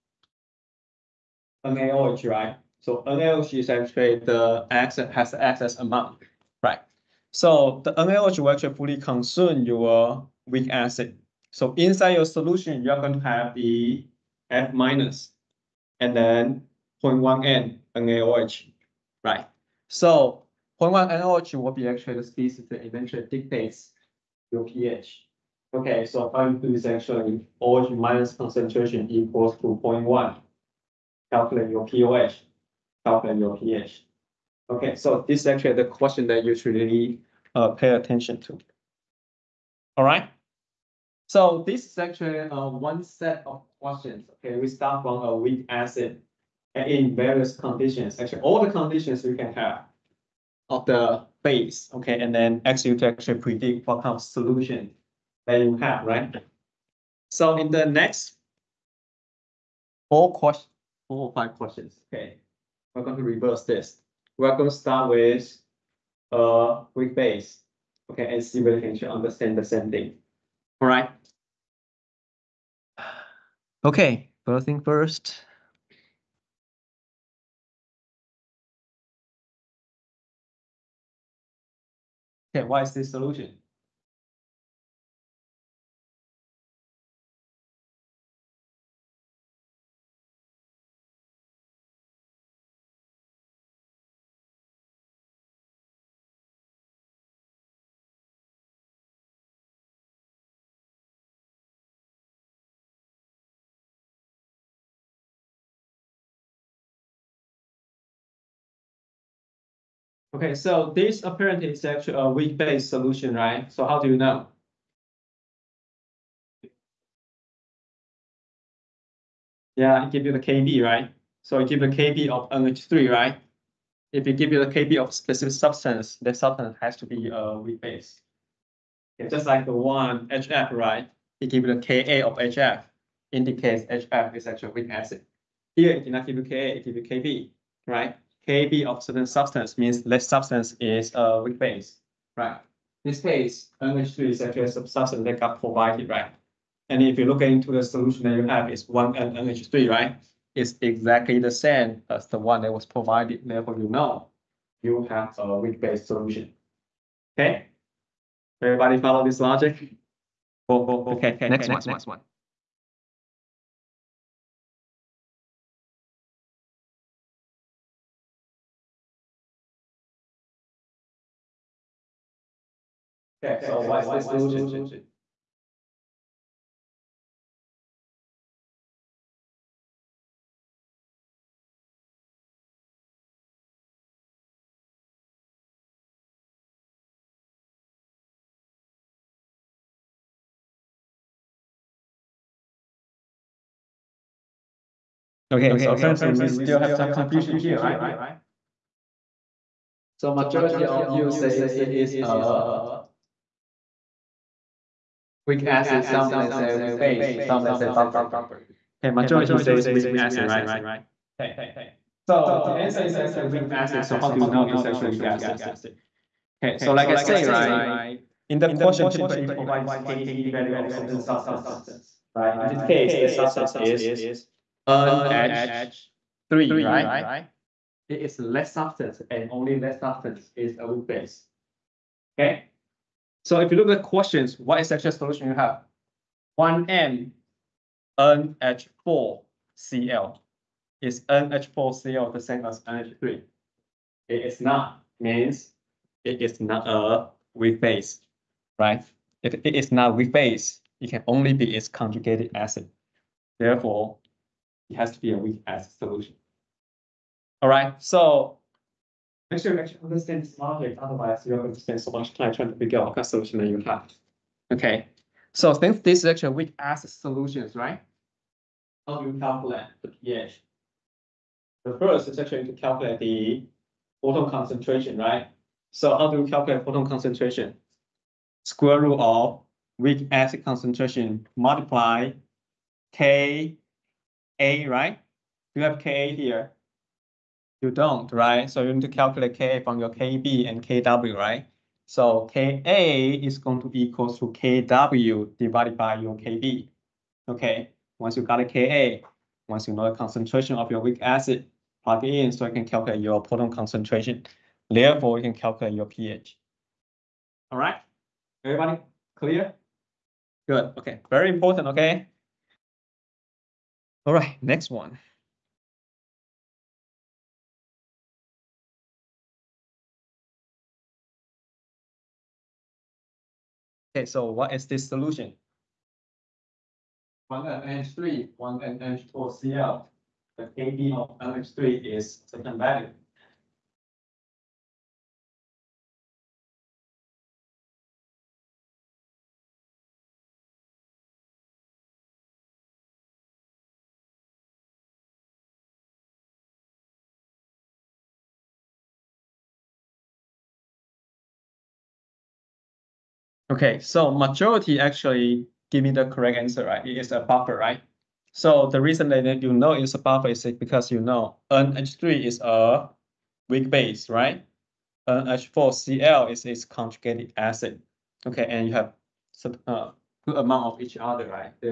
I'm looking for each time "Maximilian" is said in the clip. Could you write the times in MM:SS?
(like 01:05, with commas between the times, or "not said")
not said.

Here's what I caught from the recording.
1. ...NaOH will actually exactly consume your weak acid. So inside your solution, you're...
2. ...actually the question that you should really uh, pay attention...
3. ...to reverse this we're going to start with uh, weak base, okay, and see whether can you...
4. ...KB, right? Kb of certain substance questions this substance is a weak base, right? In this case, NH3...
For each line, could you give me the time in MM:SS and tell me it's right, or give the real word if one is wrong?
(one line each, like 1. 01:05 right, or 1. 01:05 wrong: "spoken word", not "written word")
1. 00:07 wrong: "fully", not "exactly"
2. 00:35 right
3. 01:03 right
4. 02:17 wrong: "means", not "questions".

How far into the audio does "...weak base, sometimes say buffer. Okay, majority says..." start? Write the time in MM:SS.
03:26.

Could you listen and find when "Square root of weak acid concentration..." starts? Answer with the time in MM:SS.
04:38.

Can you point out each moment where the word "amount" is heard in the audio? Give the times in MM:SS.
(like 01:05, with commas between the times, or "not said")
00:05, 06:10.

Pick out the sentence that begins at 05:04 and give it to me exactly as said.
Therefore, you can calculate your pH.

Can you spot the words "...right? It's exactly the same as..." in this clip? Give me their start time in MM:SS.
02:29.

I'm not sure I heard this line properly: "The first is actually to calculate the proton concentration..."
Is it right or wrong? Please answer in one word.
right.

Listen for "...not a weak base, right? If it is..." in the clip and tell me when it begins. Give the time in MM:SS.
04:06.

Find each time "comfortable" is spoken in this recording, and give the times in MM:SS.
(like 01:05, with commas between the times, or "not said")
not said.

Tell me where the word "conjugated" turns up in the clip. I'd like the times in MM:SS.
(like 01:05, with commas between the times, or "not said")
04:11, 06:06.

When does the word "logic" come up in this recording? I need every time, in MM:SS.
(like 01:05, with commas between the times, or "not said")
02:39, 04:20.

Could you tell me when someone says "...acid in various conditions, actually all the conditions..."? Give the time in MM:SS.
00:45.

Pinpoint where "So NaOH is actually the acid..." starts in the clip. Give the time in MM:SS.
00:02.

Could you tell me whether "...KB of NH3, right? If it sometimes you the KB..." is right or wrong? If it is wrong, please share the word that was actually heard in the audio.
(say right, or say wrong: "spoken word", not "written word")
wrong: "gives", not "sometimes".